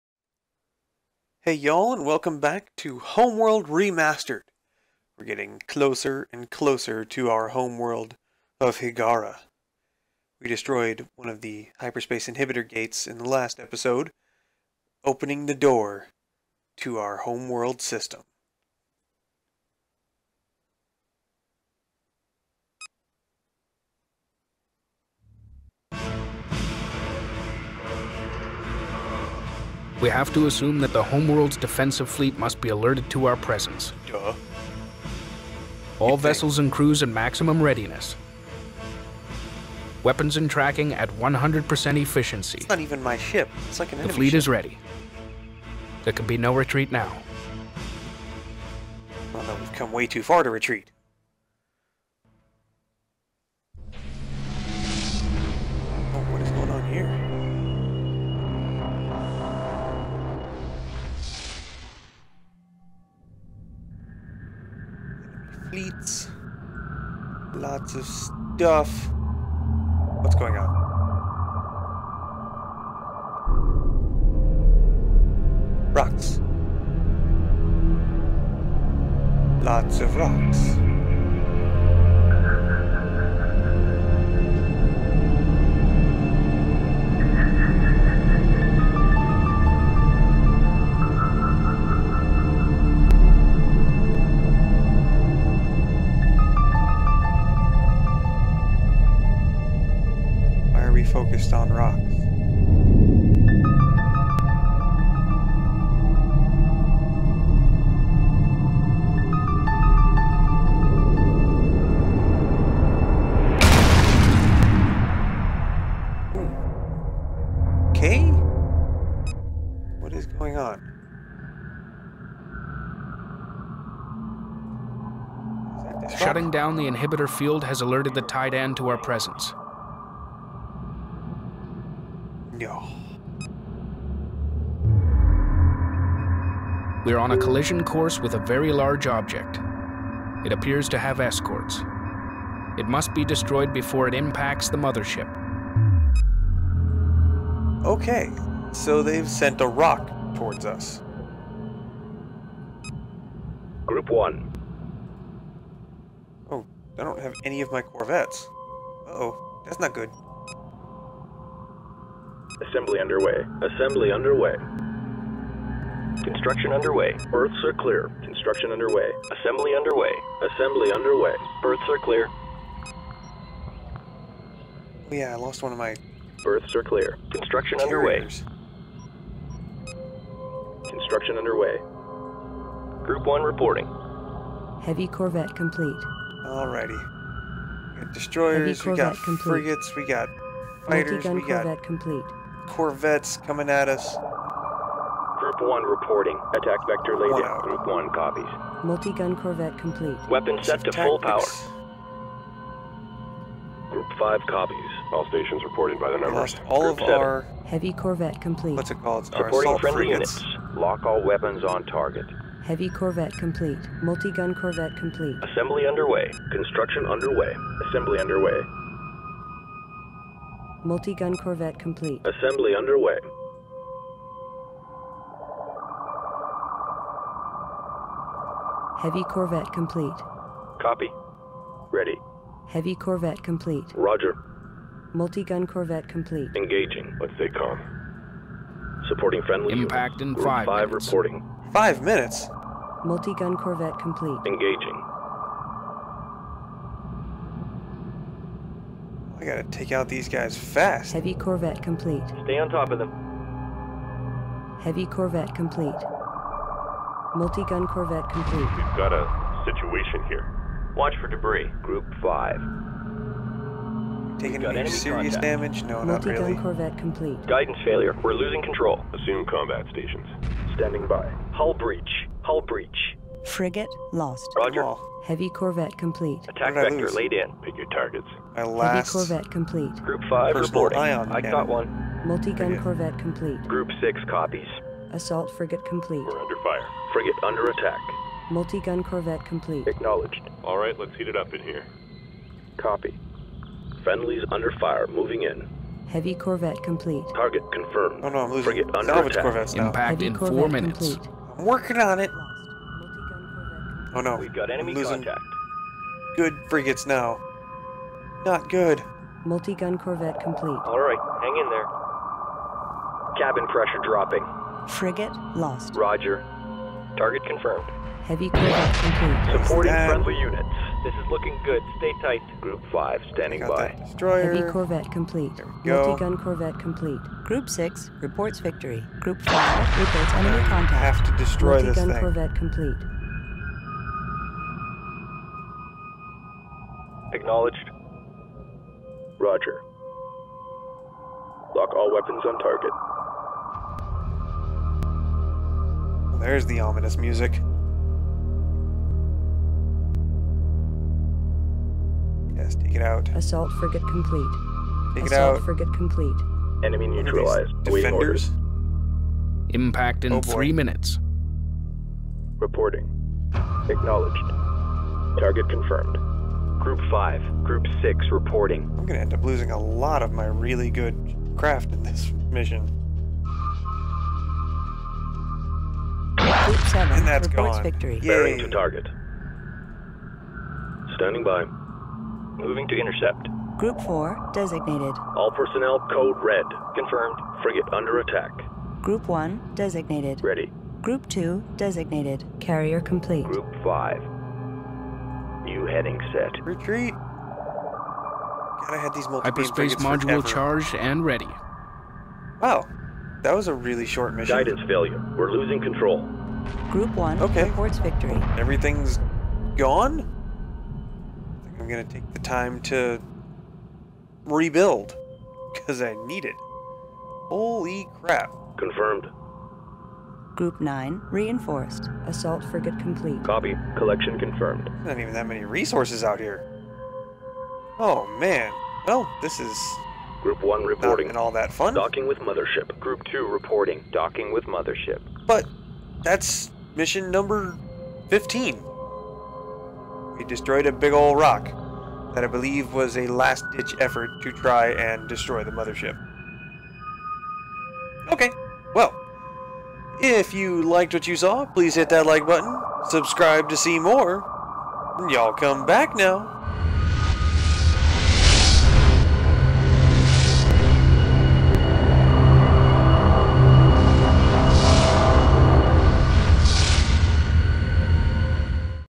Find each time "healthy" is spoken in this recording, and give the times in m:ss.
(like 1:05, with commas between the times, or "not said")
not said.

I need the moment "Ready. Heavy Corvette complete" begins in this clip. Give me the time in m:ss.
3:51.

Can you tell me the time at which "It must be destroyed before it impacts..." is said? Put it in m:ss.
2:22.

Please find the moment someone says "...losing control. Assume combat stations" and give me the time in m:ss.
4:28.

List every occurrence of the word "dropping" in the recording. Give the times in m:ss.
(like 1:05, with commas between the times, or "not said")
5:14.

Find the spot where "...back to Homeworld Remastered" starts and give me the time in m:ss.
0:02.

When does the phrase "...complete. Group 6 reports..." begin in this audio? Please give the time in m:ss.
5:26.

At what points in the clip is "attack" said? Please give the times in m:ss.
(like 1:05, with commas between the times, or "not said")
3:16, 4:36, 4:47, 4:59, 6:28.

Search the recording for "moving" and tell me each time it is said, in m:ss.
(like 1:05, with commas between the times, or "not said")
4:55, 6:22.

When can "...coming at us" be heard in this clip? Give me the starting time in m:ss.
3:13.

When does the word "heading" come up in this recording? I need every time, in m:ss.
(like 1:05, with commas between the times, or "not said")
6:35.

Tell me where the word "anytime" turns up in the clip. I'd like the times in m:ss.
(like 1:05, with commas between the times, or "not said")
not said.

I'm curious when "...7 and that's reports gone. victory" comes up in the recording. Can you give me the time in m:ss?
6:16.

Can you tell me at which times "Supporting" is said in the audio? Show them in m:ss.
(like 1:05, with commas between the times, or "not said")
3:29, 3:59, 5:19.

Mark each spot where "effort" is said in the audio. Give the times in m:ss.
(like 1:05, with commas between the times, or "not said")
7:23.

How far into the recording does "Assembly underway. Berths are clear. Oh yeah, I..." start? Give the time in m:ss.
2:50.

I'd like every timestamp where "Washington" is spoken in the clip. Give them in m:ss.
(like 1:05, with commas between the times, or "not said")
not said.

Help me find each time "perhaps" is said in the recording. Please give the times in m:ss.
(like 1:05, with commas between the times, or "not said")
not said.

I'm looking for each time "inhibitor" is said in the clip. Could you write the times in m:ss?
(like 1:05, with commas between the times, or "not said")
0:12, 2:06.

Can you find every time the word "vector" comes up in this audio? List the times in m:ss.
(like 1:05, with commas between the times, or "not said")
3:16, 4:36.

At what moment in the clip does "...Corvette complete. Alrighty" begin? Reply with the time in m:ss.
3:05.